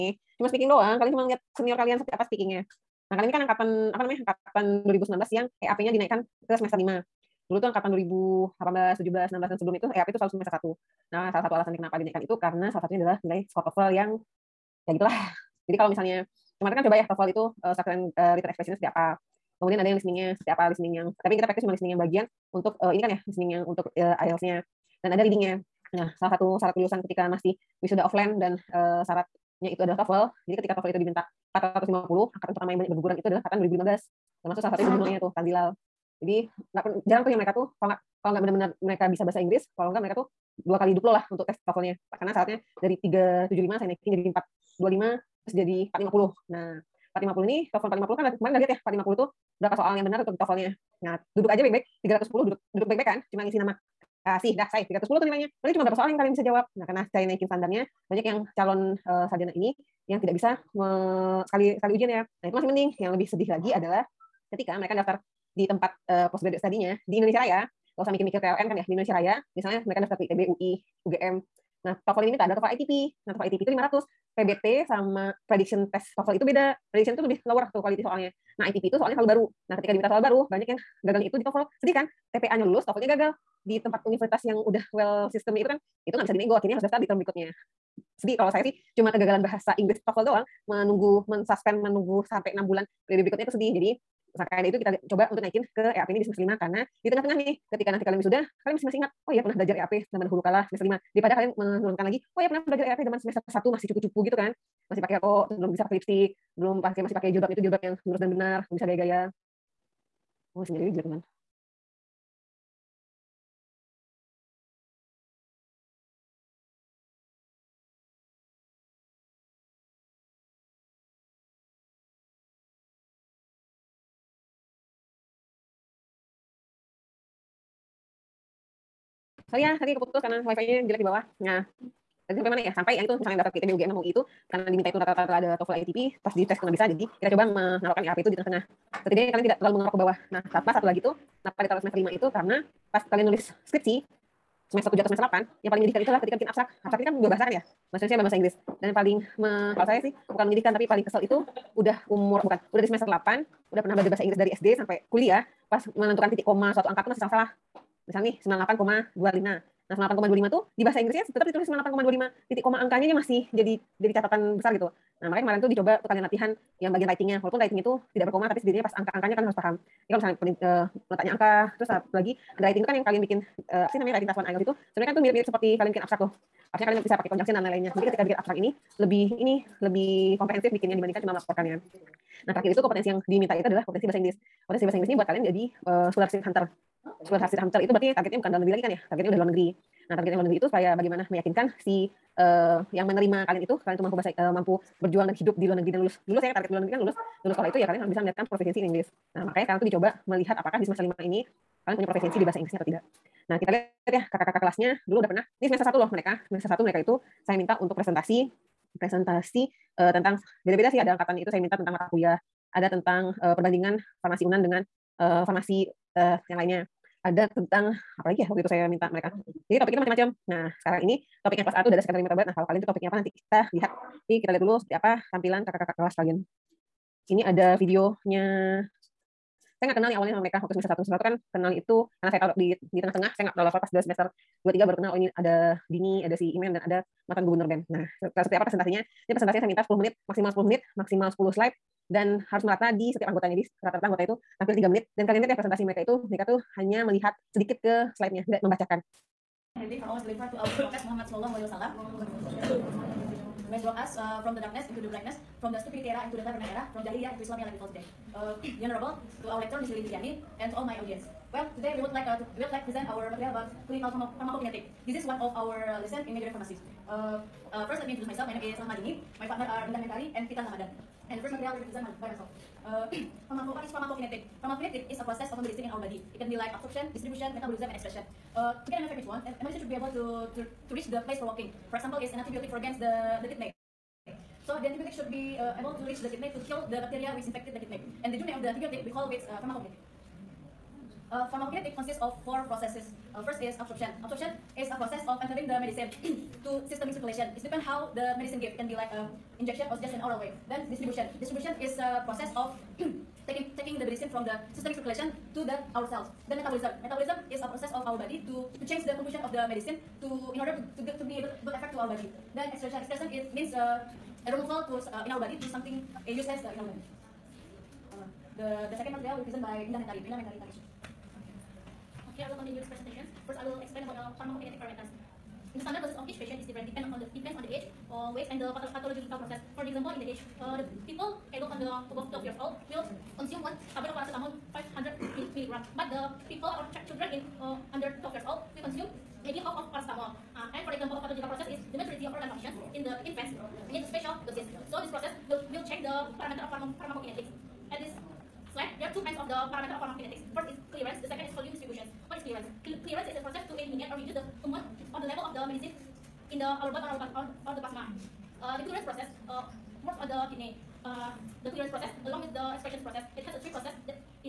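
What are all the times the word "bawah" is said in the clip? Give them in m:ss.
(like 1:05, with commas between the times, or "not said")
2:11, 2:19.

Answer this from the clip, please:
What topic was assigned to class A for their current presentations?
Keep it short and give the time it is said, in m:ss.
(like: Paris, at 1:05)
secondary metabolite, at 3:42.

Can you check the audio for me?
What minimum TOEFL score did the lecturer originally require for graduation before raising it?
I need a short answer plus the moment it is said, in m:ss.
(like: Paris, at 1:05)
375, at 0:43.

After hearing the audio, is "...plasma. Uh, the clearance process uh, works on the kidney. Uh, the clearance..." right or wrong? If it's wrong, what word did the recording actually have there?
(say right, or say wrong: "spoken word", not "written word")
right.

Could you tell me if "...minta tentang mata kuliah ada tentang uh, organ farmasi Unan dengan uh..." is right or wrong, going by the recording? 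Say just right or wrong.
wrong.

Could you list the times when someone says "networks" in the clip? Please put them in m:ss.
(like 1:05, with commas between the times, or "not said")
not said.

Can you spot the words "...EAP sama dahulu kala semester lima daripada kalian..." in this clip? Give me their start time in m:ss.
1:39.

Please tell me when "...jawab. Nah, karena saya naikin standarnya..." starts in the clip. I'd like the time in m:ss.
0:56.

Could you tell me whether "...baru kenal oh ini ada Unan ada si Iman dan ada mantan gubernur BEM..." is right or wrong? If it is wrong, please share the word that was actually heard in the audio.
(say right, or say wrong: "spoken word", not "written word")
wrong: "Dini", not "Unan".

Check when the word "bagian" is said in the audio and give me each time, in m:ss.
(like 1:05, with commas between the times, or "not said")
0:21, 2:46.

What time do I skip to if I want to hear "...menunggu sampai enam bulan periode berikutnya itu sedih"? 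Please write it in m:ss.
1:31.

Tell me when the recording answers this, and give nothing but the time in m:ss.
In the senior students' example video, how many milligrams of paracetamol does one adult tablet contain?
5:34.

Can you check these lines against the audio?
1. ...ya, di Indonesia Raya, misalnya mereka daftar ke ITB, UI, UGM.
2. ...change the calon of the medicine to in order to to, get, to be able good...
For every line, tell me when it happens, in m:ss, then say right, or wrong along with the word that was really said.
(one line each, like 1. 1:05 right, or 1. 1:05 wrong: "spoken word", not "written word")
1. 1:08 right
2. 5:08 wrong: "composition", not "calon".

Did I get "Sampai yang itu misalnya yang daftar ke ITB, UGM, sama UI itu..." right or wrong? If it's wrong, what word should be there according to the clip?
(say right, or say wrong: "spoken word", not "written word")
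right.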